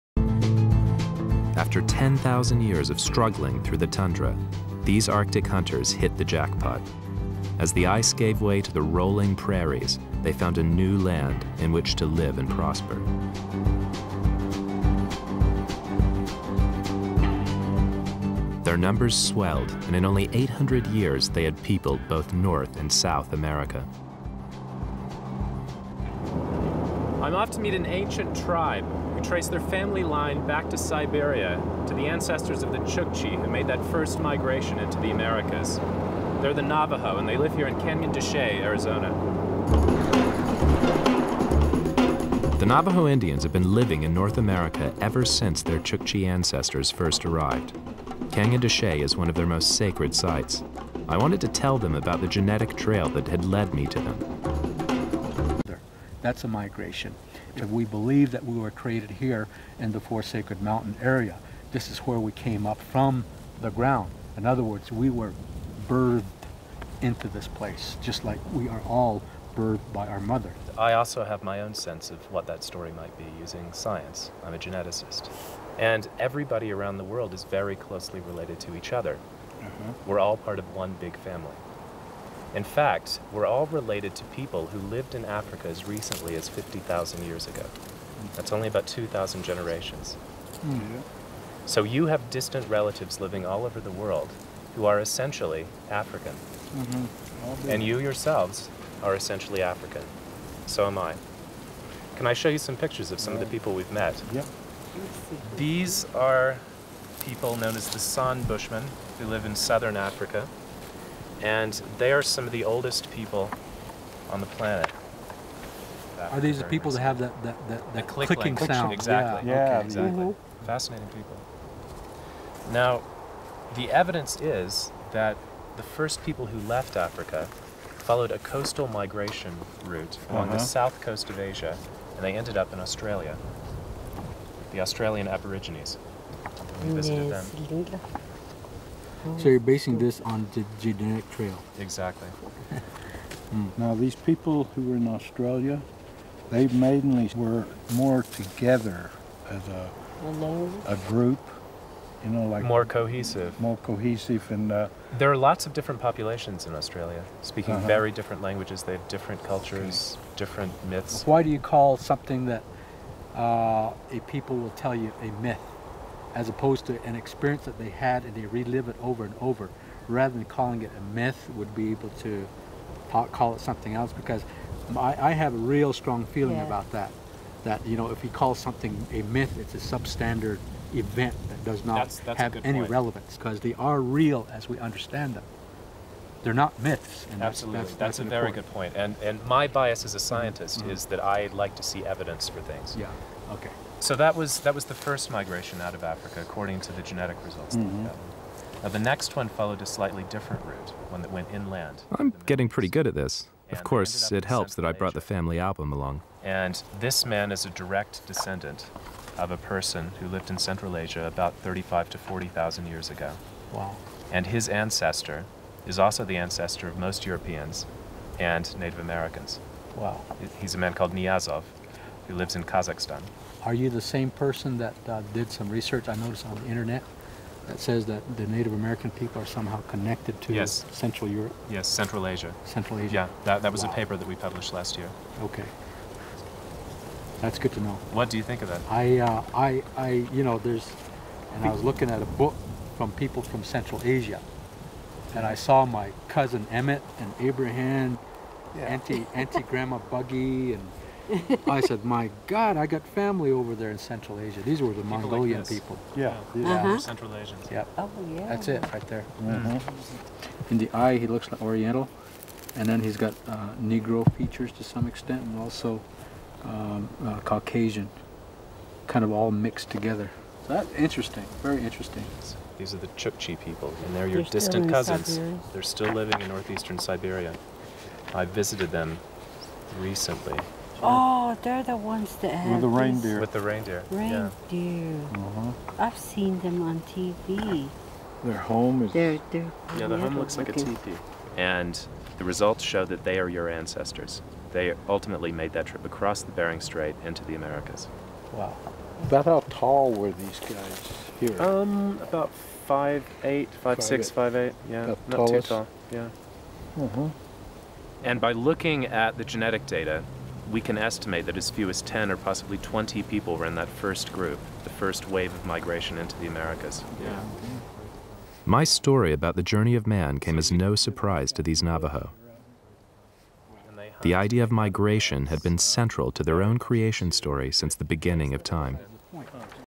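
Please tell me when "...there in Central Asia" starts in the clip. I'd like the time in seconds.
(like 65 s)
253 s.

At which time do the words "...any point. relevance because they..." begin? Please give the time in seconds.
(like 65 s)
182 s.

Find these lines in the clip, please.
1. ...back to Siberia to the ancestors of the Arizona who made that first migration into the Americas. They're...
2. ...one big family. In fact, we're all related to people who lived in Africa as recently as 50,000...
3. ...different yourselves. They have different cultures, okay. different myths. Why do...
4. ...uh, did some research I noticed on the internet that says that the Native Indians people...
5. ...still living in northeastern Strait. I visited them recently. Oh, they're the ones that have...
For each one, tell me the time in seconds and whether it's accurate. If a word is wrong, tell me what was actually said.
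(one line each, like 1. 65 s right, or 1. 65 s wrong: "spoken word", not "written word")
1. 30 s wrong: "Chukchi", not "Arizona"
2. 80 s right
3. 158 s wrong: "languages", not "yourselves"
4. 225 s wrong: "American", not "Indians"
5. 275 s wrong: "Siberia", not "Strait".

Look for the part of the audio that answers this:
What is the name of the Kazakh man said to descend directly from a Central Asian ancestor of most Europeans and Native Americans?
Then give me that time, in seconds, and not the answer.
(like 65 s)
221 s.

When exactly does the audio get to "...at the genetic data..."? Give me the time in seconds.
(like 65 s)
309 s.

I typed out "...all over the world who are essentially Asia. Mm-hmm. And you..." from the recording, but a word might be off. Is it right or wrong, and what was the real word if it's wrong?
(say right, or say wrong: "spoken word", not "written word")
wrong: "African", not "Asia".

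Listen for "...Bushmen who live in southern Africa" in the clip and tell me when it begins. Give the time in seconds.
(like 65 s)
108 s.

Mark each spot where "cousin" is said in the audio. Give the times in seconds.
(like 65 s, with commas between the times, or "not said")
246 s, 274 s.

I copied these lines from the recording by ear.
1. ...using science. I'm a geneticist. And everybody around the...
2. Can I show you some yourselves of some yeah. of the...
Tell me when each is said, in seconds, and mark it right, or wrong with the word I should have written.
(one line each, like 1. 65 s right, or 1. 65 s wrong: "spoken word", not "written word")
1. 73 s right
2. 102 s wrong: "pictures", not "yourselves".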